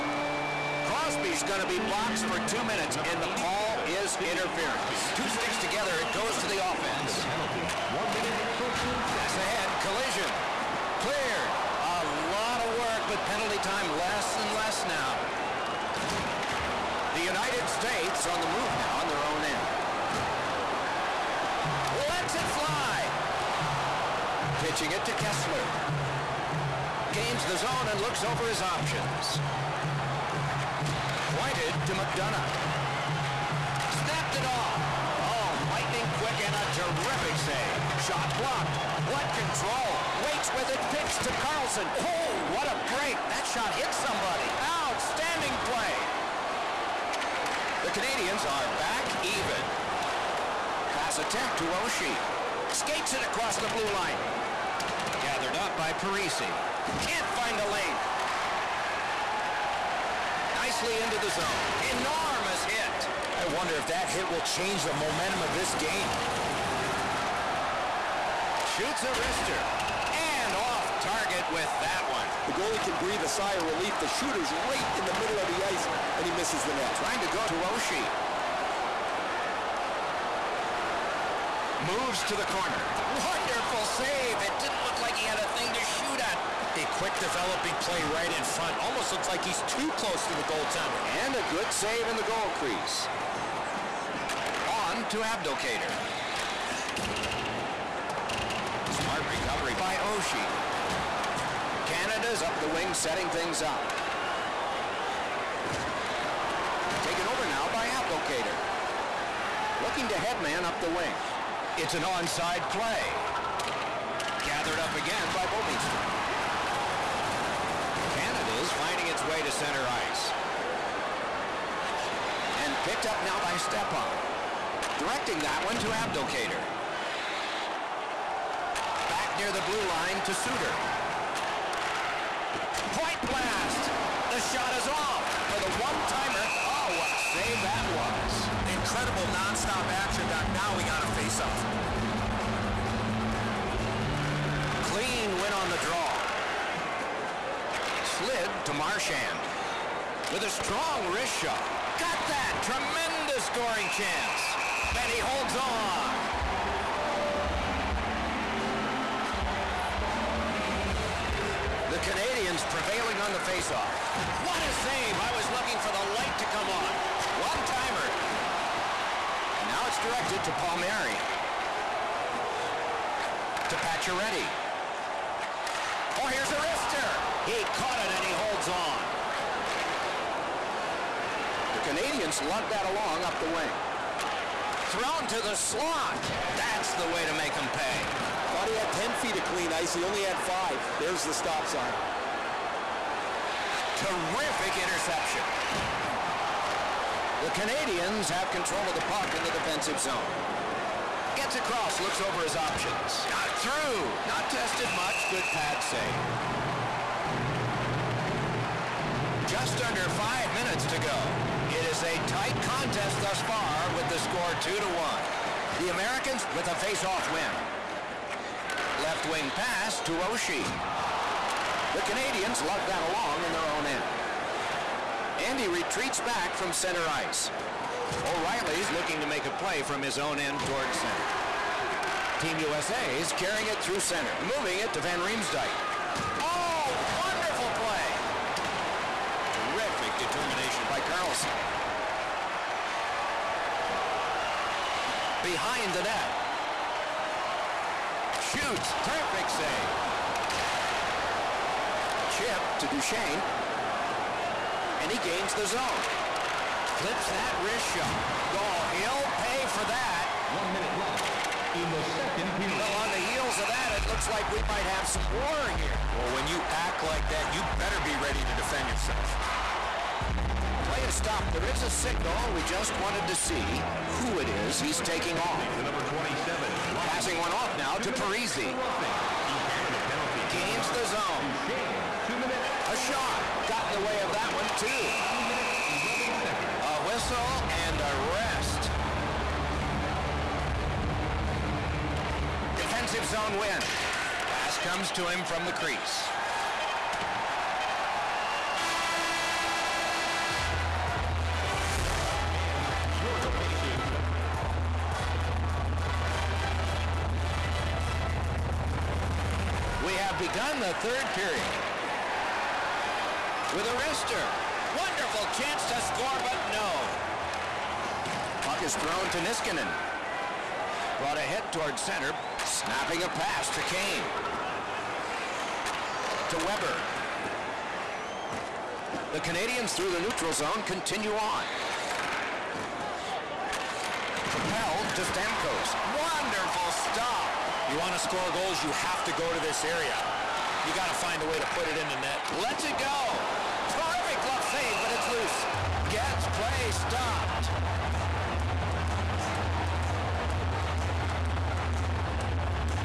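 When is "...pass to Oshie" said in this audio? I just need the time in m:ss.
3:39.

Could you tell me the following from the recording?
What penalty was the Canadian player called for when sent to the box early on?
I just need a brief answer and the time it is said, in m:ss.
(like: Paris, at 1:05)
Interference, at 0:04.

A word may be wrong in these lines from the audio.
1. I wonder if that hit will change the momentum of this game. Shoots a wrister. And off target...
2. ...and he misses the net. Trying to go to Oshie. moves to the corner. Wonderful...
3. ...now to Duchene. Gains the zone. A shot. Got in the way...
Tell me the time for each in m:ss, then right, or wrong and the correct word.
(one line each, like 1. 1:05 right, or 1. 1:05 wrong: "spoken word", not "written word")
1. 1:03 right
2. 1:16 right
3. 4:37 wrong: "Parise", not "Duchene".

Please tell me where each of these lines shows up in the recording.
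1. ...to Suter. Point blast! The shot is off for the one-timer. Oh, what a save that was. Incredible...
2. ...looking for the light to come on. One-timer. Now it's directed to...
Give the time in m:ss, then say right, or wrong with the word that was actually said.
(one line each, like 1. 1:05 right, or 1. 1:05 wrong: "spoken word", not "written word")
1. 2:10 right
2. 2:45 right.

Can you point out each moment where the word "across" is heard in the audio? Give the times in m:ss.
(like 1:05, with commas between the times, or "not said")
0:53, 3:21.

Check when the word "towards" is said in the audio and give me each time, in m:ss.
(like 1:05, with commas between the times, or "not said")
3:50, 5:21.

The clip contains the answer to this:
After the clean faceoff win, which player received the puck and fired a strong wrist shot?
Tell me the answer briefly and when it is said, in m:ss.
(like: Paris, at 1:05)
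Marchand, at 2:28.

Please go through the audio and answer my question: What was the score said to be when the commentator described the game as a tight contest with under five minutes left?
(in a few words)
2 to 1.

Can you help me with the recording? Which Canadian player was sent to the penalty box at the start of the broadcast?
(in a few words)
Crosby.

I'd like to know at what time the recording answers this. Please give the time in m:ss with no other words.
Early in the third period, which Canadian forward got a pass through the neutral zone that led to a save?
5:35.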